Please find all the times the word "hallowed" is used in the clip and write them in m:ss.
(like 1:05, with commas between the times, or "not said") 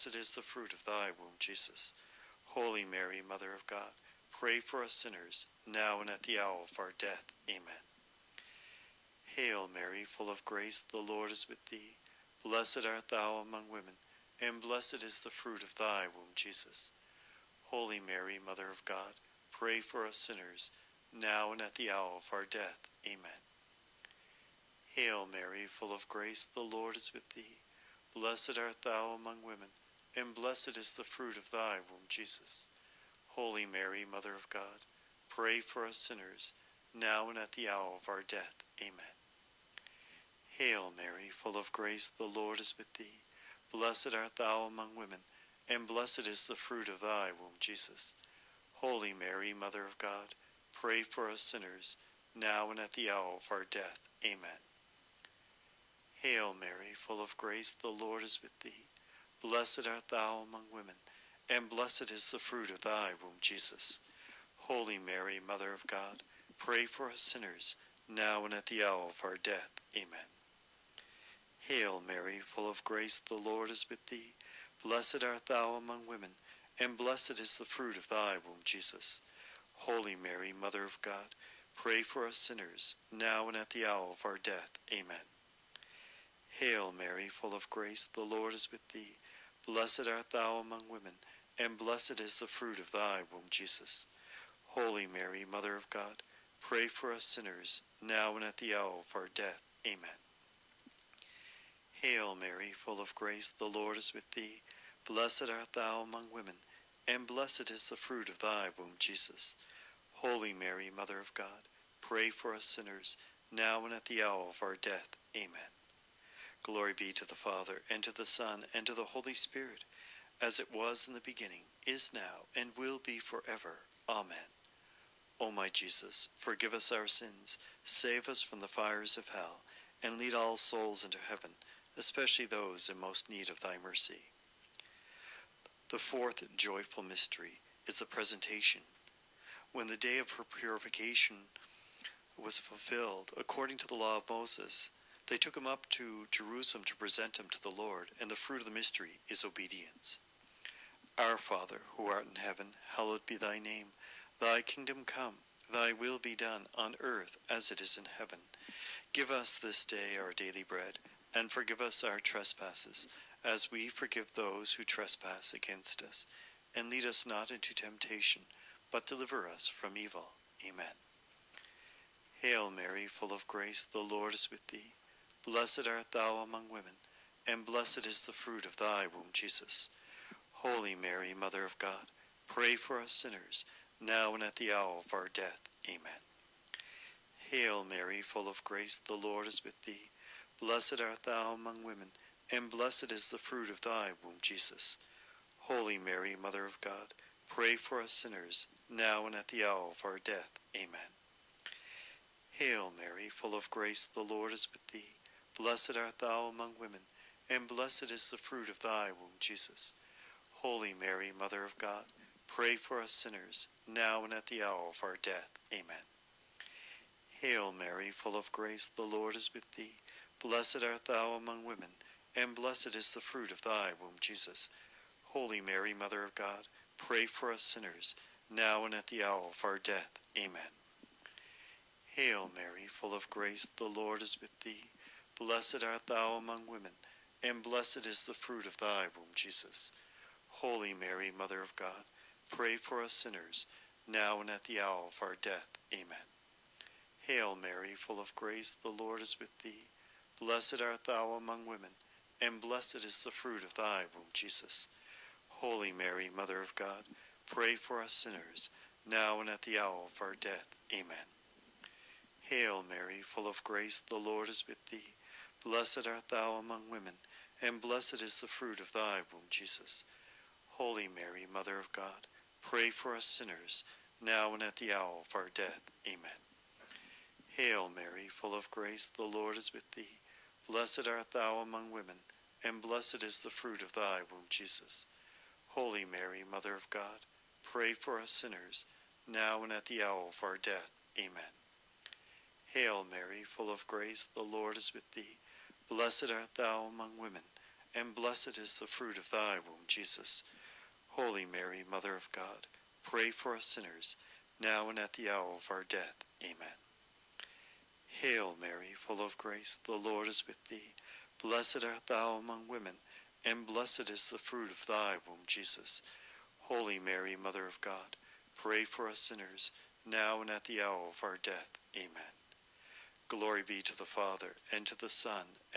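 2:32.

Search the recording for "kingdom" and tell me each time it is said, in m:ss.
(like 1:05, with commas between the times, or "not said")
2:34.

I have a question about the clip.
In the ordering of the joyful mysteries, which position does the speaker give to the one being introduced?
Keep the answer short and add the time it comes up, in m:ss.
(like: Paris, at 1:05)
Fourth, at 2:15.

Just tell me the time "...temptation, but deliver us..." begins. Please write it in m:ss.
2:47.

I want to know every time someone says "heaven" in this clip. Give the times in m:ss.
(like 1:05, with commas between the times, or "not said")
2:11, 2:32, 2:38.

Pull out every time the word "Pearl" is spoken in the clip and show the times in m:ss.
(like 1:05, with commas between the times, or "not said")
not said.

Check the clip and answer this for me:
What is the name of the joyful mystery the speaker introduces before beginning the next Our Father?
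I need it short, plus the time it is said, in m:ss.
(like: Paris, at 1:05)
The Presentation, at 2:17.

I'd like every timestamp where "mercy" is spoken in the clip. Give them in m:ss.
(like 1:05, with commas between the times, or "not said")
2:13.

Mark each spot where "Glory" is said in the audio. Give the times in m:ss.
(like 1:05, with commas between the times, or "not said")
1:56, 5:23.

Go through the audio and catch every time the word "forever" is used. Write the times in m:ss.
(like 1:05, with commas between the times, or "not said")
2:03.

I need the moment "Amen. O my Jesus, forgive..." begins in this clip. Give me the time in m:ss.
2:04.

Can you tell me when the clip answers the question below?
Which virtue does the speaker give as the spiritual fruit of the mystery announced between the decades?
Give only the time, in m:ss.
2:29.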